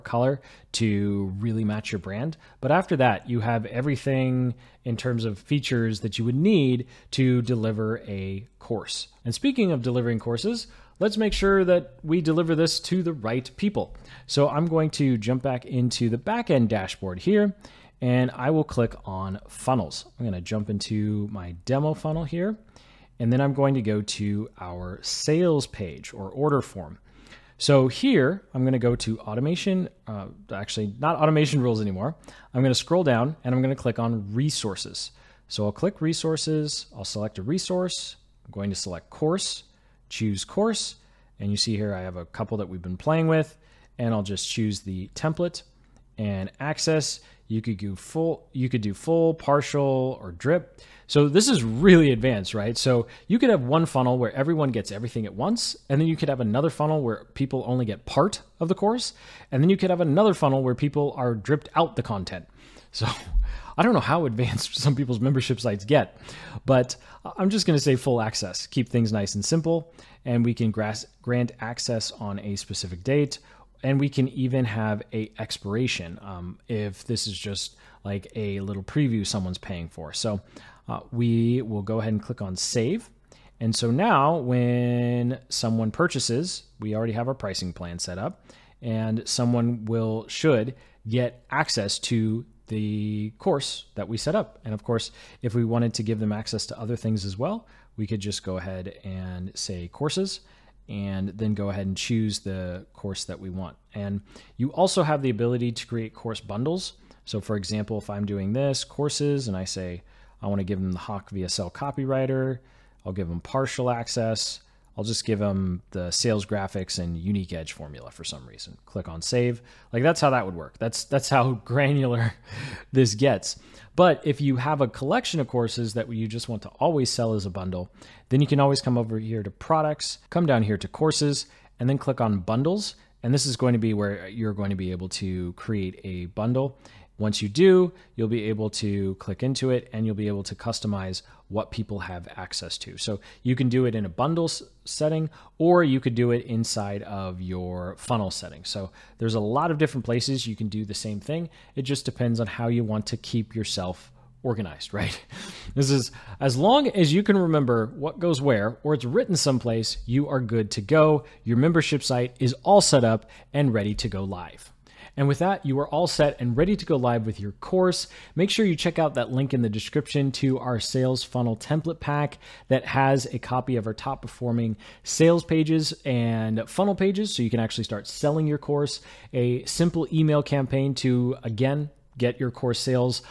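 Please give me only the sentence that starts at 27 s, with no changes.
So here, I'm going to go to automation, uh, actually not automation rules anymore.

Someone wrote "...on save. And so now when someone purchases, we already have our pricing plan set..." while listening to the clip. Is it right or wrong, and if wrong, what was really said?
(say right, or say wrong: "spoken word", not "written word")
right.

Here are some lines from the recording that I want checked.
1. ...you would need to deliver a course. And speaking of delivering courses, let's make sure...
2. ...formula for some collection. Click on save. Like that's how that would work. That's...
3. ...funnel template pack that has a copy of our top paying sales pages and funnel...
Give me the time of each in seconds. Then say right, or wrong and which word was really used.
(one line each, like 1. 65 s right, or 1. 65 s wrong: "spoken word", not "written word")
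1. 6 s right
2. 117 s wrong: "reason", not "collection"
3. 171 s wrong: "performing", not "paying".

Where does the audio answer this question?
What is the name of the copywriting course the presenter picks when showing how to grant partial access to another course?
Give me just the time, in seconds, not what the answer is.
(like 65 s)
110 s.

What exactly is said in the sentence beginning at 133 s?
And this is going to be where you're going to be able to create a bundle.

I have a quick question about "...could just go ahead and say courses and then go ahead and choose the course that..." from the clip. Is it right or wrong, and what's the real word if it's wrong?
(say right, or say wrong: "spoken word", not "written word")
right.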